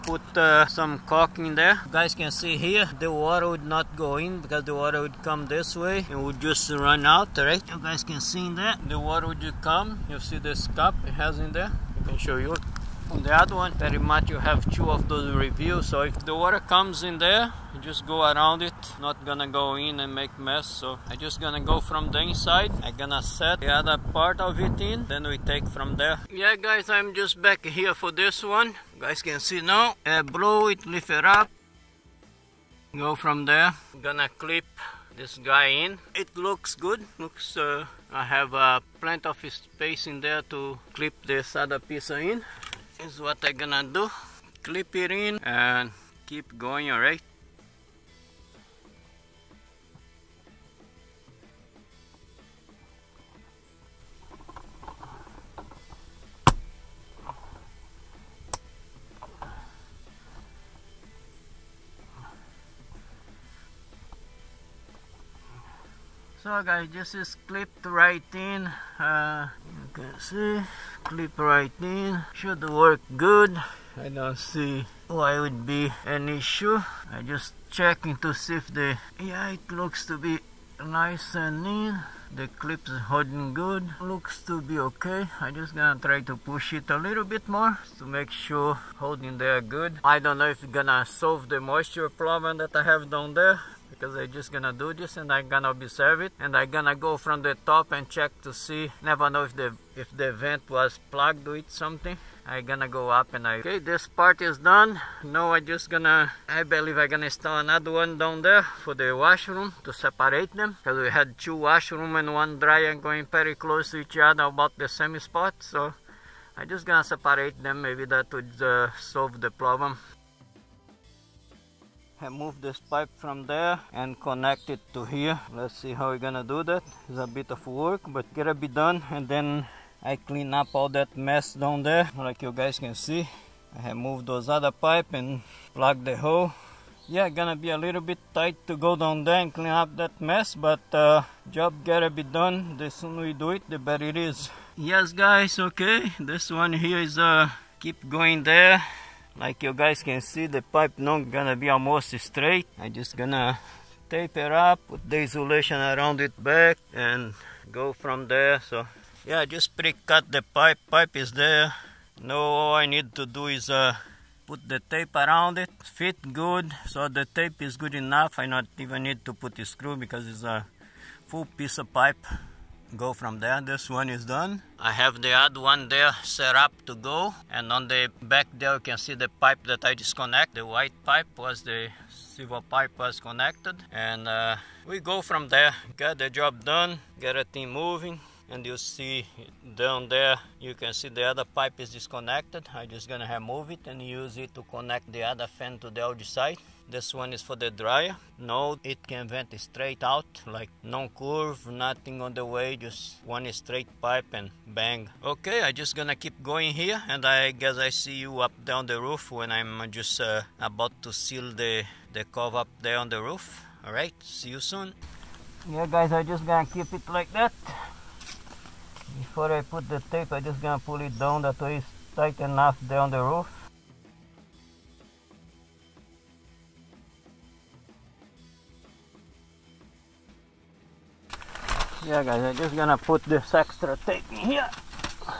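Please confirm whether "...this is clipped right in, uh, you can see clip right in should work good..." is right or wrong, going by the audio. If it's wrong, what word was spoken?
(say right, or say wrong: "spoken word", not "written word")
right.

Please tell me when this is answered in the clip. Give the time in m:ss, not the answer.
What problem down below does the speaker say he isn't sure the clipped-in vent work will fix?
1:31.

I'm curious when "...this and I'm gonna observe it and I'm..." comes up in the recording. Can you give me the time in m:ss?
1:34.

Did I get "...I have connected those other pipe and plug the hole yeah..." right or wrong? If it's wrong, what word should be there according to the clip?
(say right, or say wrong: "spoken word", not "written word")
wrong: "moved", not "connected".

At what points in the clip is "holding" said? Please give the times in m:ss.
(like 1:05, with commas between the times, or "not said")
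1:23, 1:29.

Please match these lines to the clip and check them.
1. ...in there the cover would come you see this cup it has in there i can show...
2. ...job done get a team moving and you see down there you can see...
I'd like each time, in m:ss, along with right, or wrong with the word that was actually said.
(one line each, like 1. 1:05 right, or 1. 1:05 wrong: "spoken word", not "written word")
1. 0:08 wrong: "water", not "cover"
2. 3:06 right.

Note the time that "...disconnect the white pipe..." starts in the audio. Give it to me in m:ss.
2:59.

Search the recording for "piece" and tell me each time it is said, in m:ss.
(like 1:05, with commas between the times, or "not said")
0:41, 2:51.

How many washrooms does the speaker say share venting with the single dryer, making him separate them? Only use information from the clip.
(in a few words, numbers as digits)
2.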